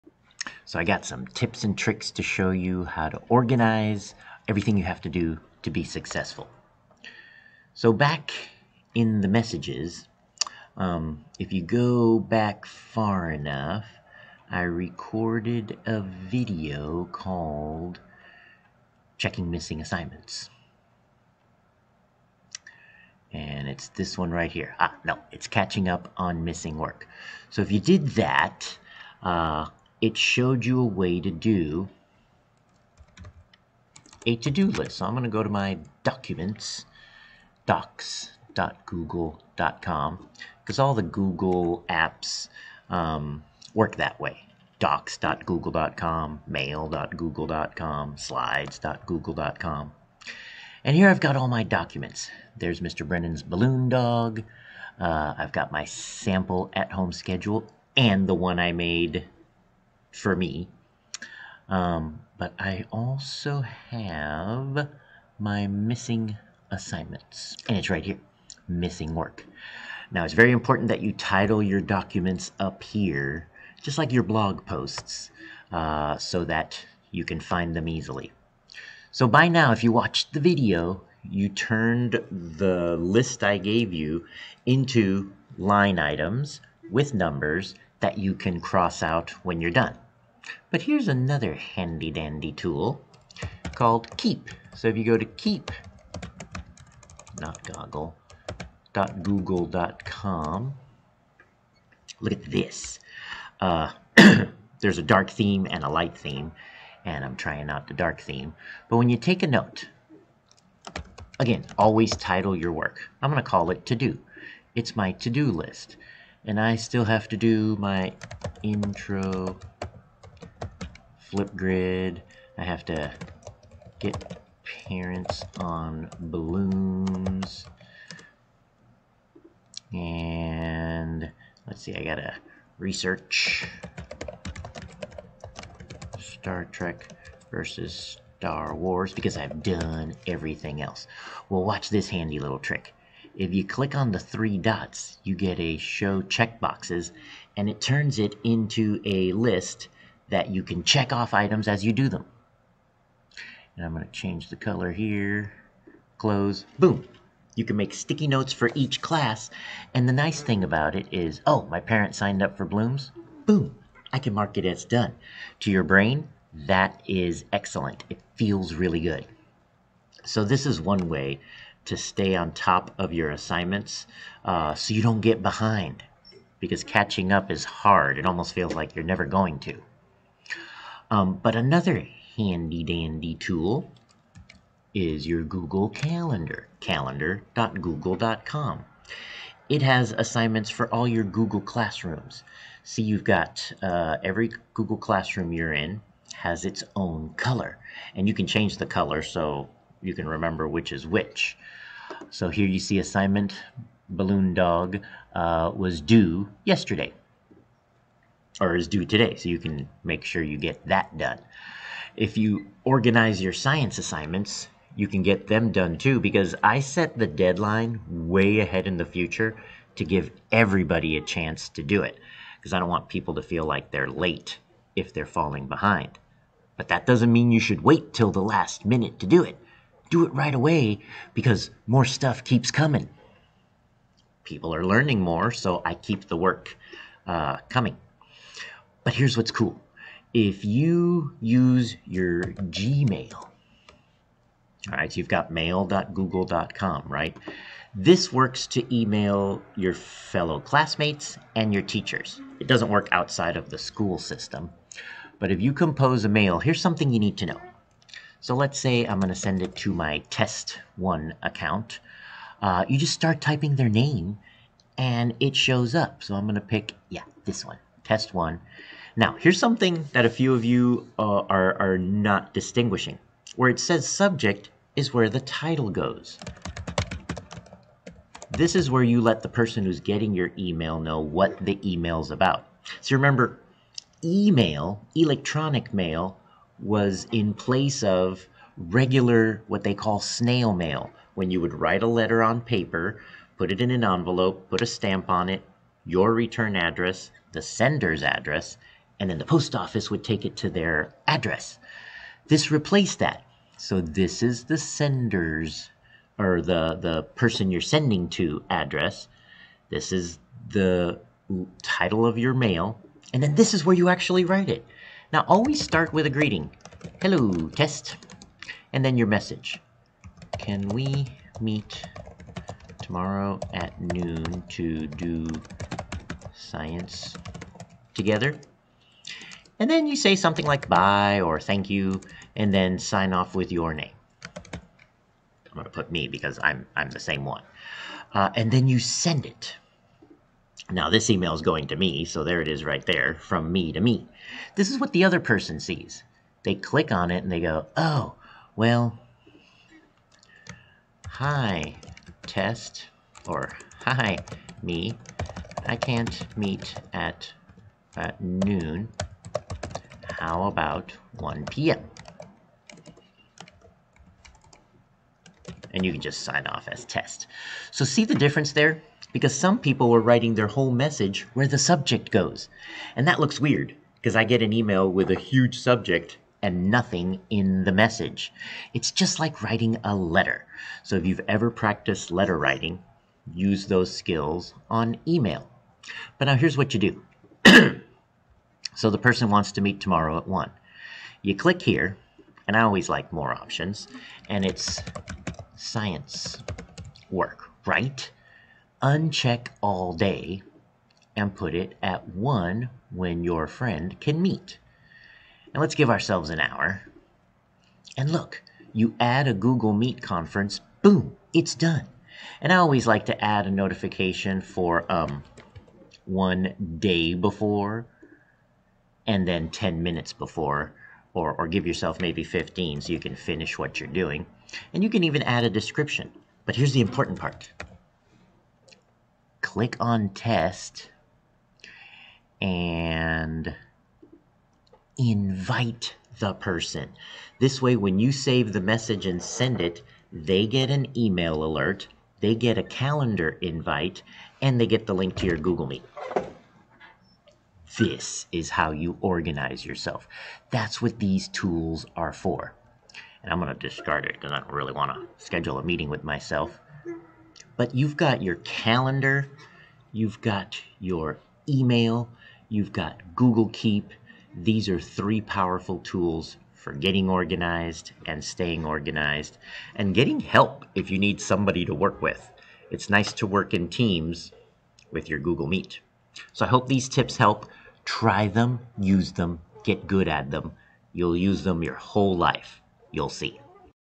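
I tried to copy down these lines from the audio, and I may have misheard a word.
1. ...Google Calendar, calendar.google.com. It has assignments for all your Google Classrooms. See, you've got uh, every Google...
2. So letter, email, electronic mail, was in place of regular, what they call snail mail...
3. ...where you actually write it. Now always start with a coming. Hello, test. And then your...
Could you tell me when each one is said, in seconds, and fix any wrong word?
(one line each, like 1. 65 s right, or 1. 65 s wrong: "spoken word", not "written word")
1. 185 s right
2. 283 s wrong: "remember", not "letter"
3. 313 s wrong: "greeting", not "coming".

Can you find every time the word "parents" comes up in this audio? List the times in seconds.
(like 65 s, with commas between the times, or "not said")
124 s, 161 s.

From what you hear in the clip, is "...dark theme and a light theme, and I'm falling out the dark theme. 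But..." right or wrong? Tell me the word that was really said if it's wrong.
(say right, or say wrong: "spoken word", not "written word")
wrong: "trying", not "falling".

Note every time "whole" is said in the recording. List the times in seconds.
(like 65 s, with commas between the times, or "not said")
370 s, 482 s.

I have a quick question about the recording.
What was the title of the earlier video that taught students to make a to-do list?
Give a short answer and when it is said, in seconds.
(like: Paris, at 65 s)
Catching up on missing work, at 25 s.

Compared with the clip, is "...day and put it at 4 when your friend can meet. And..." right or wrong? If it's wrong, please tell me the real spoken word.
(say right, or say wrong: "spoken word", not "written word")
wrong: "1", not "4".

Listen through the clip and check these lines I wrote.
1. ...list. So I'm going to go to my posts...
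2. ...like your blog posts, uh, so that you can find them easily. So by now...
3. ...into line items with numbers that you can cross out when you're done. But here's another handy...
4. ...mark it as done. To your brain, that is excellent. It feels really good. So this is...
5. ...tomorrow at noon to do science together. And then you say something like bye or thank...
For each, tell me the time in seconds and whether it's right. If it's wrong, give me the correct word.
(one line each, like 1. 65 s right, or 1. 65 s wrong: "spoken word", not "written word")
1. 34 s wrong: "documents", not "posts"
2. 73 s right
3. 84 s right
4. 164 s right
5. 323 s right.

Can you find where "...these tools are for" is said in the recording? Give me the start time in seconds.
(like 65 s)
451 s.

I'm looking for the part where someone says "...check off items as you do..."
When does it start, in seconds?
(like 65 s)
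150 s.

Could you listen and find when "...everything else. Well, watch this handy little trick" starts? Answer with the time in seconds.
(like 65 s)
140 s.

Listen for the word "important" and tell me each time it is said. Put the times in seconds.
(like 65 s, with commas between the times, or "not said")
70 s, 427 s.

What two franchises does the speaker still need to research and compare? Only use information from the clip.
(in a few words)
Star Trek versus Star Wars.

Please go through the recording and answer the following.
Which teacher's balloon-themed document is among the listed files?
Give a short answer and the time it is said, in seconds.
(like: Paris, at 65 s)
Mr. Brennan, at 52 s.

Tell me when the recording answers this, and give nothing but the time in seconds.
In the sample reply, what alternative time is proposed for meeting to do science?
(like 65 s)
361 s.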